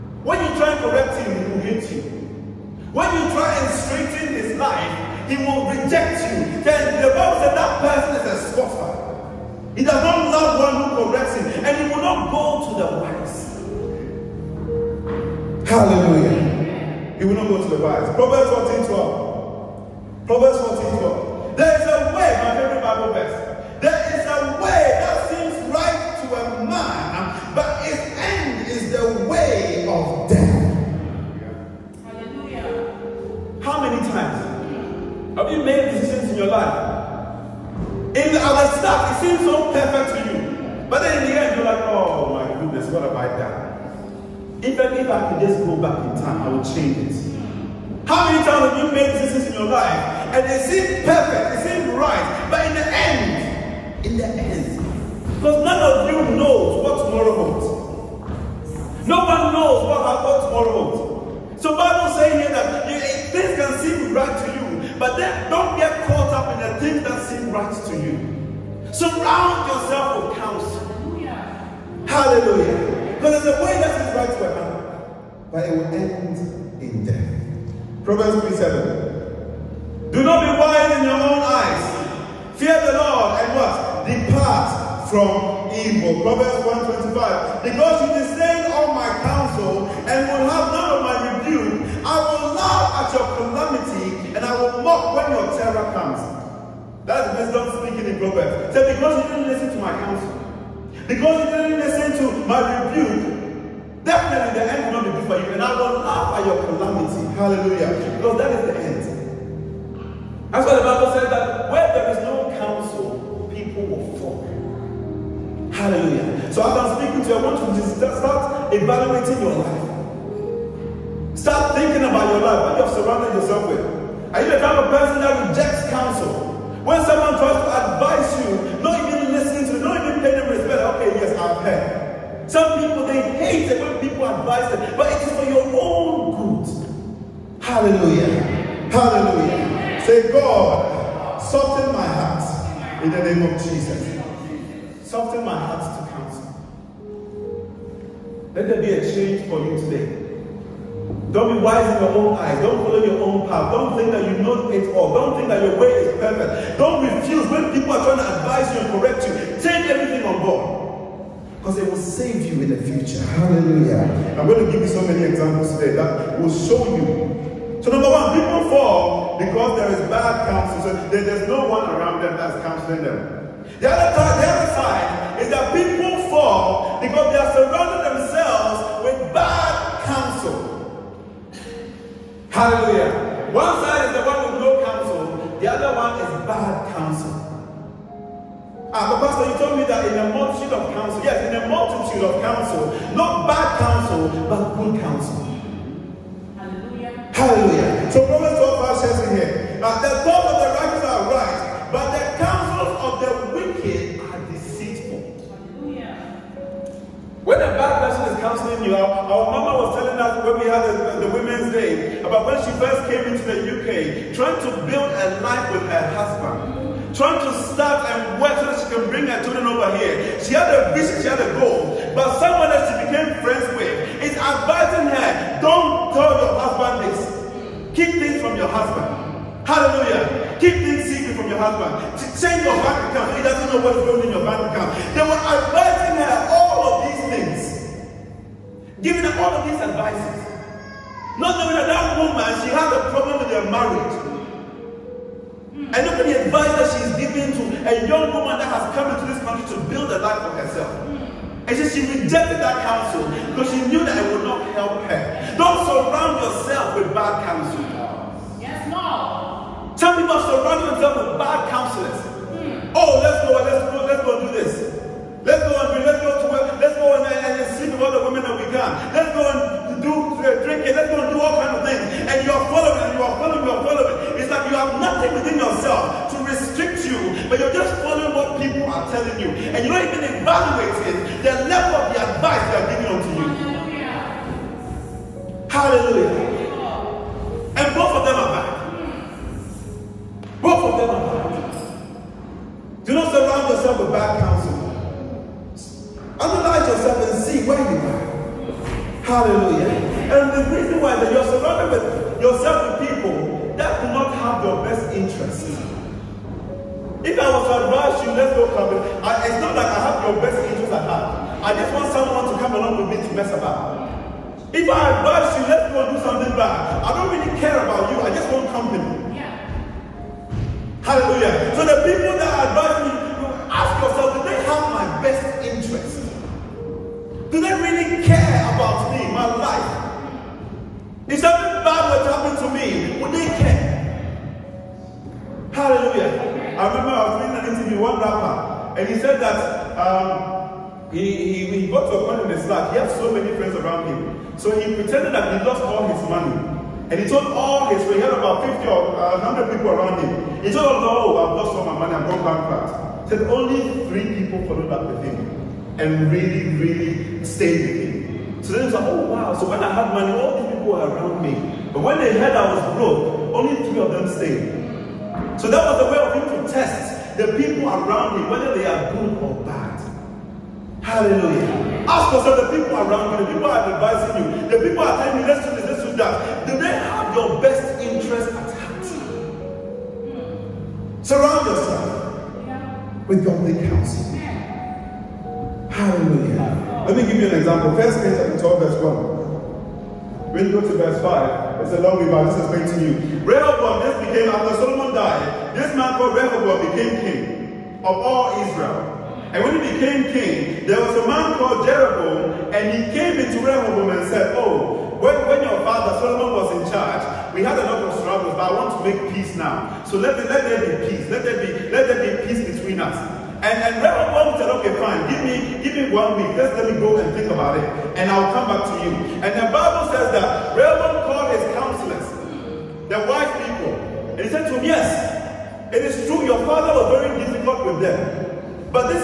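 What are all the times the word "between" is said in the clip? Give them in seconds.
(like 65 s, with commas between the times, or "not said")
412 s.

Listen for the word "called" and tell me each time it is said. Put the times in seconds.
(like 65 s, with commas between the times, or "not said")
396 s, 401 s, 421 s.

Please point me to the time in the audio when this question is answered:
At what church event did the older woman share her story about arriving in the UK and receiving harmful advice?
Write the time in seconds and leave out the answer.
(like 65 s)
211 s.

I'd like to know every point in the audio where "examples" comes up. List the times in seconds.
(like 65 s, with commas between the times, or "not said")
165 s, 387 s.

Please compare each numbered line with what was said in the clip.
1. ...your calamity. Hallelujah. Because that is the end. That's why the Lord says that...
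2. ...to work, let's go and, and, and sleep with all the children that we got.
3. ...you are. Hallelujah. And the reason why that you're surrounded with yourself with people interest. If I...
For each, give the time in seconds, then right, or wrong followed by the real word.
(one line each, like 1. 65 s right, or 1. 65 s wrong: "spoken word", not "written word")
1. 106 s wrong: "Bible", not "Lord"
2. 266 s wrong: "women", not "children"
3. 297 s right.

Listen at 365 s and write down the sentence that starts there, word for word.
So that was the way of him to test the people around him, whether they are good or bad.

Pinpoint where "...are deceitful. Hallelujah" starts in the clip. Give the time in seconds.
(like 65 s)
204 s.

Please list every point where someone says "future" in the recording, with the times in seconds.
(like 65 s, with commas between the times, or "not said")
162 s.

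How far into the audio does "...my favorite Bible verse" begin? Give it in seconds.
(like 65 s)
22 s.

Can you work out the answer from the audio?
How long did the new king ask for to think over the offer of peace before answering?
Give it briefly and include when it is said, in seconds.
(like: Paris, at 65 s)
One week, at 416 s.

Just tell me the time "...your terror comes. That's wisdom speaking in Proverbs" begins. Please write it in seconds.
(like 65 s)
95 s.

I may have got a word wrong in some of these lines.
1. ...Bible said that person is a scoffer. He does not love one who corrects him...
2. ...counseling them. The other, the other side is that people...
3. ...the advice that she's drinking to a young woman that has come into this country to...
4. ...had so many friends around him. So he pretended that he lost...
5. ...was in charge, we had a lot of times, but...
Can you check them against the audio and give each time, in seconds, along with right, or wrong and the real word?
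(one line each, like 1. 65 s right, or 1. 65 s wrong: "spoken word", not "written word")
1. 7 s right
2. 172 s right
3. 246 s wrong: "giving", not "drinking"
4. 342 s right
5. 406 s wrong: "struggles", not "times".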